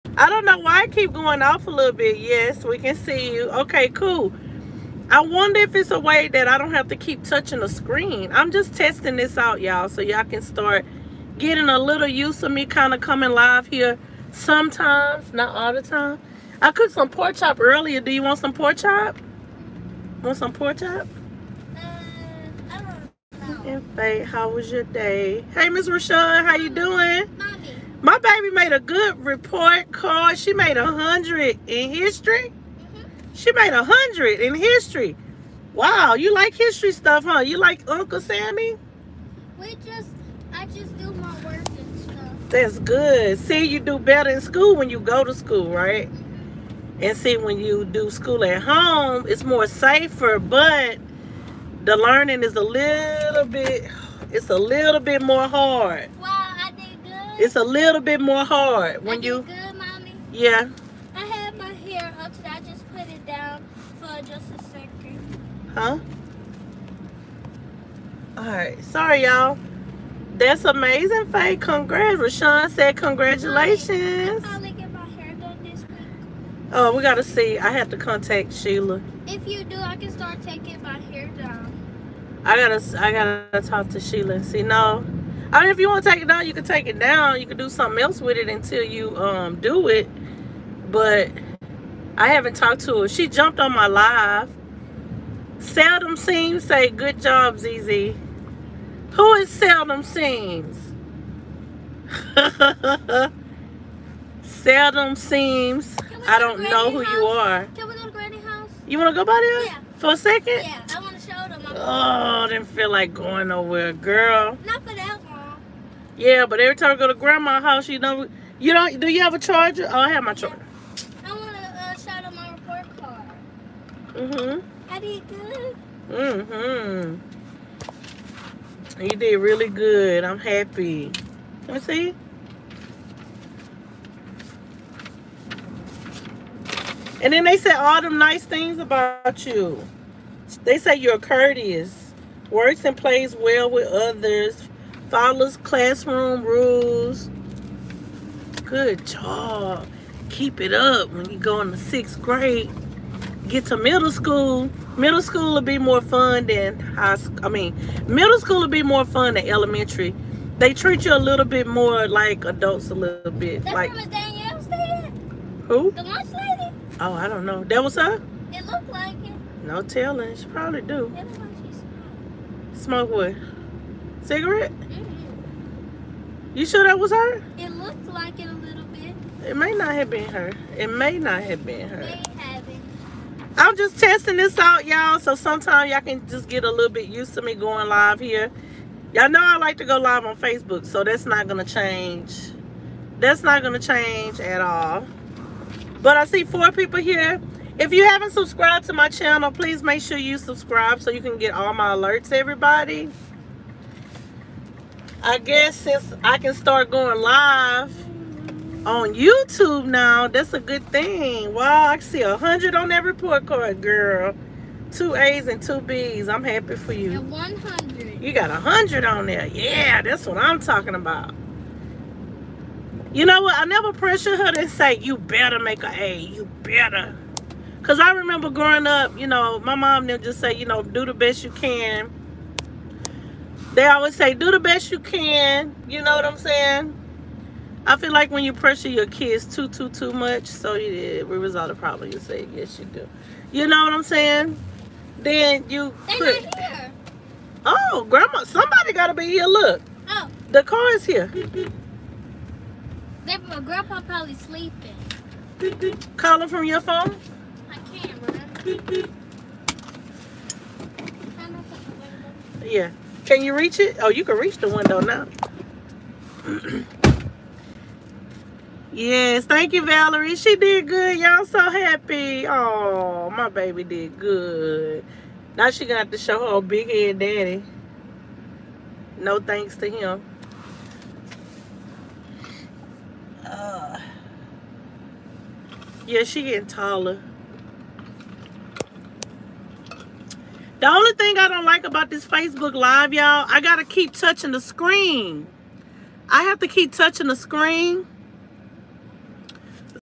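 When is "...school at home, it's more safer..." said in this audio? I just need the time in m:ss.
0:48.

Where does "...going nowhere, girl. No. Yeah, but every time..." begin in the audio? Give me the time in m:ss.
1:53.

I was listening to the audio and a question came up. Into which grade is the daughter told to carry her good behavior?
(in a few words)
Sixth grade.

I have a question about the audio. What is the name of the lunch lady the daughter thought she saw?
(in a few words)
Danielle.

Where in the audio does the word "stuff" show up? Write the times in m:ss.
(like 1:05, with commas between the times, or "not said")
0:36, 0:41.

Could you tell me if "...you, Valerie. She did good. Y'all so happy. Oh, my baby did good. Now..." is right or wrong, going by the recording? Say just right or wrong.
right.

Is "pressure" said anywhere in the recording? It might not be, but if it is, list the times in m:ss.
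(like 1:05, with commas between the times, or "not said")
3:43, 3:58.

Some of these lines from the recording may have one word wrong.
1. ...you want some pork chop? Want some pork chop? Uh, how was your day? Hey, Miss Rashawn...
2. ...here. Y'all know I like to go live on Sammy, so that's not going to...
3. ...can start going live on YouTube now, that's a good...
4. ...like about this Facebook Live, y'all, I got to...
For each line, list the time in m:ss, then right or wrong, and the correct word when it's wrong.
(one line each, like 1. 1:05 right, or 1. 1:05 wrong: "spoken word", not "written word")
1. 0:18 right
2. 3:08 wrong: "Facebook", not "Sammy"
3. 3:26 right
4. 4:51 right.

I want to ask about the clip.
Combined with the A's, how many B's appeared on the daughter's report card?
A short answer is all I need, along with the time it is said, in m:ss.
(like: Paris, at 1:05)
2, at 3:35.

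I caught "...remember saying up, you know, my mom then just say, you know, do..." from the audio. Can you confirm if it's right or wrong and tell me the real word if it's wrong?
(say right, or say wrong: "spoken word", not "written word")
wrong: "growing", not "saying".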